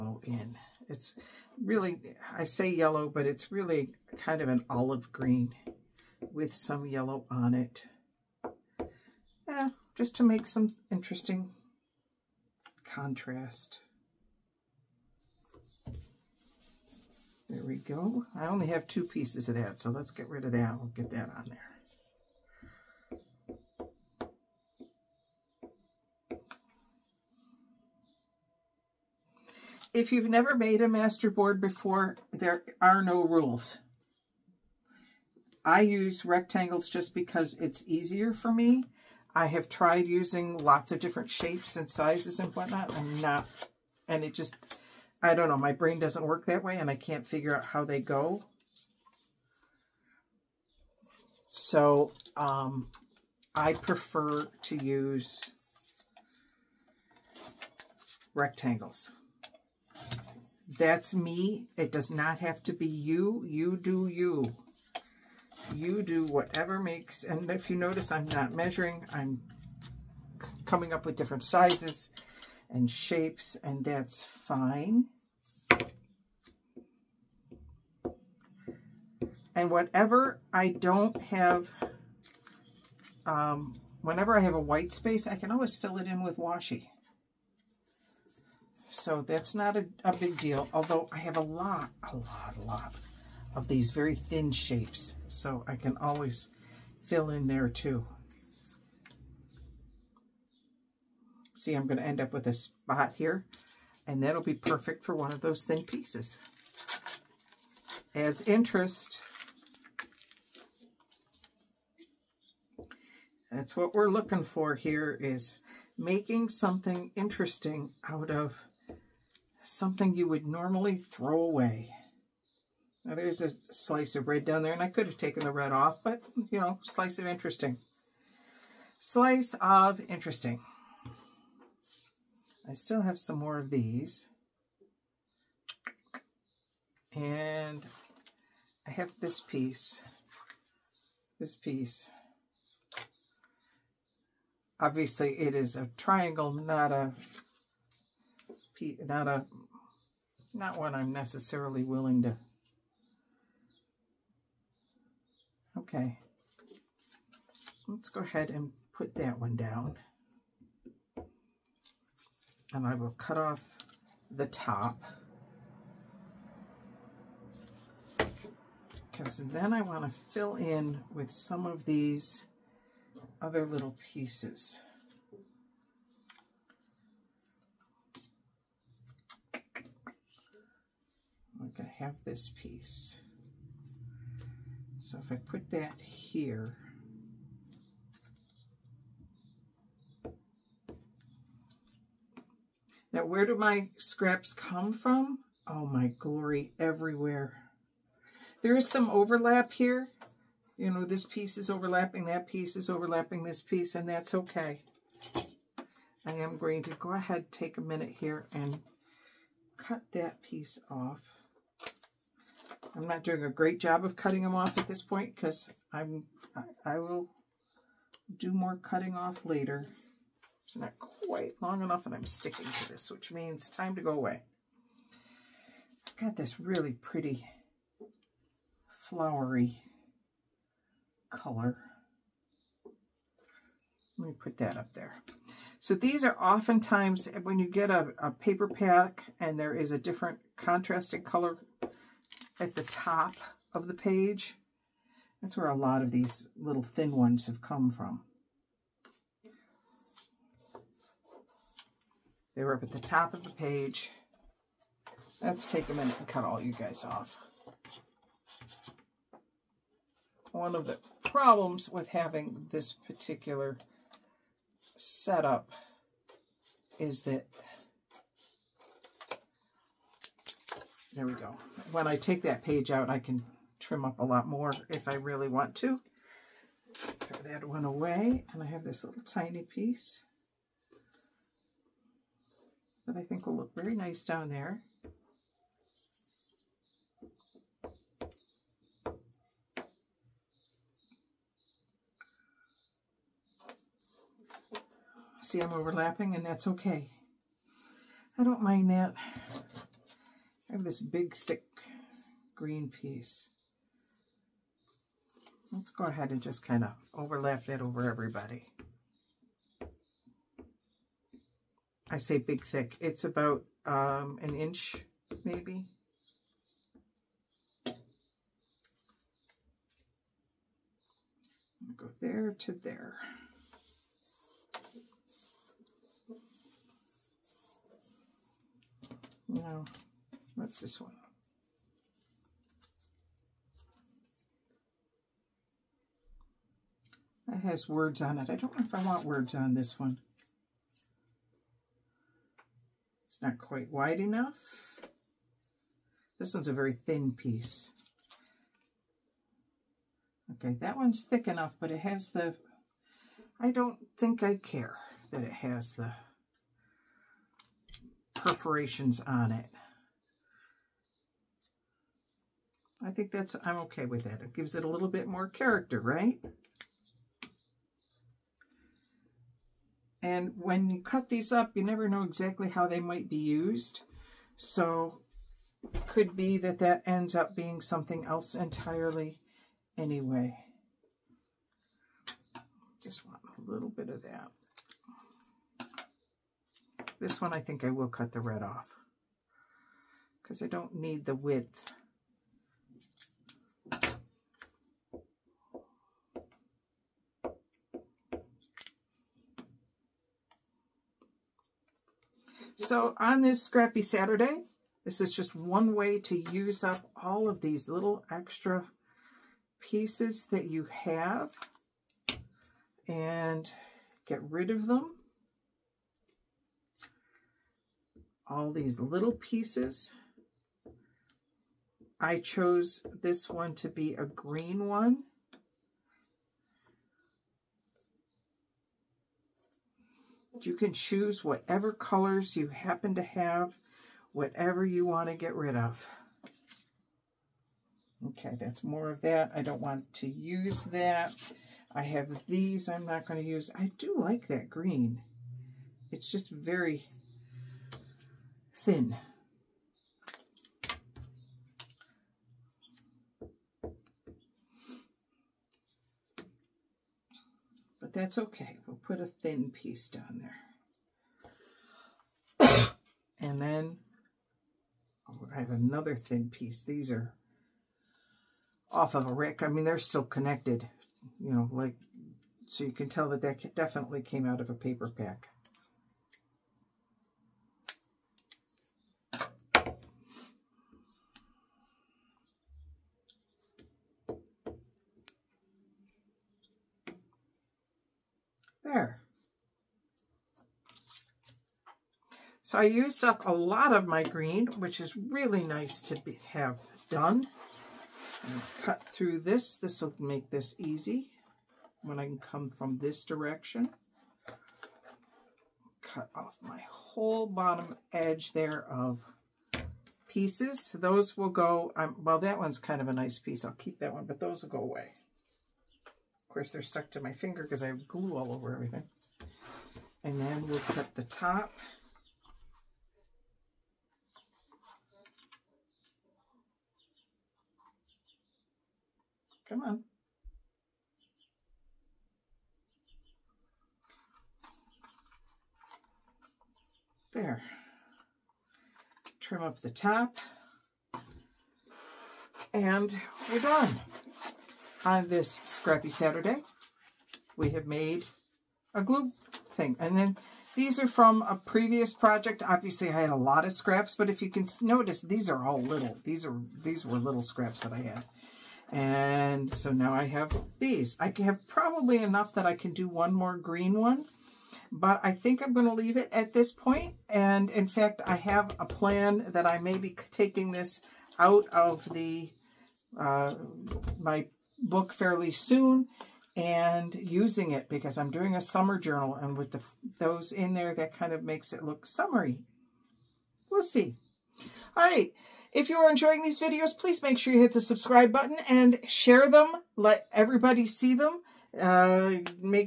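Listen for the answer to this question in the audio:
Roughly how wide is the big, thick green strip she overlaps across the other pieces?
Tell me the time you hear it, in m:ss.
5:14.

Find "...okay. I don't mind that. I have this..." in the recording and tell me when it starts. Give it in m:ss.
4:56.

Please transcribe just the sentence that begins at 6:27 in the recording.
This one I think I will cut the red off because I don't need the width.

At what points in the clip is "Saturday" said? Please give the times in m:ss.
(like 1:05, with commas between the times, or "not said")
6:44, 9:06.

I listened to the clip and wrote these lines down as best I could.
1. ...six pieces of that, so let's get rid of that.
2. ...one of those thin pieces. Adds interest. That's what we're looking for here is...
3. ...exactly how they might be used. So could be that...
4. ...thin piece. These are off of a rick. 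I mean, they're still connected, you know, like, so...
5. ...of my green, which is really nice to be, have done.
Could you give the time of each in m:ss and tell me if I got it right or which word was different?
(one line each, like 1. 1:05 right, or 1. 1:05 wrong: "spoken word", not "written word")
1. 0:18 wrong: "two", not "six"
2. 1:45 right
3. 6:12 right
4. 7:46 right
5. 8:13 right.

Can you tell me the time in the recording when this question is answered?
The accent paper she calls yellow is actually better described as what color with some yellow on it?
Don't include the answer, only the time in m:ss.
0:04.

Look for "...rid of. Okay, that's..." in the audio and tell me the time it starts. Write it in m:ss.
7:15.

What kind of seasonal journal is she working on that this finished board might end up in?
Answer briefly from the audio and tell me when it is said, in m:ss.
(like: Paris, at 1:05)
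a summer journal, at 9:38.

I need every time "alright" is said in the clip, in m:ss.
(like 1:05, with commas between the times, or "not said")
not said.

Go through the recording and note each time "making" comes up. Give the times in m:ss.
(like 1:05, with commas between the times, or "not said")
1:55.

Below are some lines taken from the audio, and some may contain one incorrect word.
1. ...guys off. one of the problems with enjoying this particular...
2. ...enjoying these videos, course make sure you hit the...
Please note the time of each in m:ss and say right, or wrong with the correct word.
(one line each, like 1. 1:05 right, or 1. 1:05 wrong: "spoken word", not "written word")
1. 4:16 wrong: "having", not "enjoying"
2. 9:46 wrong: "please", not "course".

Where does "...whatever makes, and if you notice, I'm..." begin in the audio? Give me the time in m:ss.
1:06.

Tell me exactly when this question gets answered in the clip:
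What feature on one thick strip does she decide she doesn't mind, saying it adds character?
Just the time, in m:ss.
5:58.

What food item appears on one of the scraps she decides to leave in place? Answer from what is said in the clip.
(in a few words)
a slice of bread.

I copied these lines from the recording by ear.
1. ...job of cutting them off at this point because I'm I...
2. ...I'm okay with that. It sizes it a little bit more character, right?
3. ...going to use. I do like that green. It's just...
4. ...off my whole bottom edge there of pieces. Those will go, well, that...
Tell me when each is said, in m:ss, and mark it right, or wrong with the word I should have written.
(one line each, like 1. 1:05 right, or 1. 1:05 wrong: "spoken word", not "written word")
1. 3:33 right
2. 6:03 wrong: "gives", not "sizes"
3. 7:23 right
4. 8:26 right.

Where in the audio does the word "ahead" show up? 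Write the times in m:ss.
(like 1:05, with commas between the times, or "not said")
2:38, 3:27, 5:06.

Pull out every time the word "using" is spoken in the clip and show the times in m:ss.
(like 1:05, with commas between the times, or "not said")
0:40, 9:37.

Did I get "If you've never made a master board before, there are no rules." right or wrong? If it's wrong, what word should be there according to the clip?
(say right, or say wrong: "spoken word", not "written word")
right.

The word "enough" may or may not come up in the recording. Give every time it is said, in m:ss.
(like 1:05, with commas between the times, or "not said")
3:41, 5:44, 5:51, 9:22.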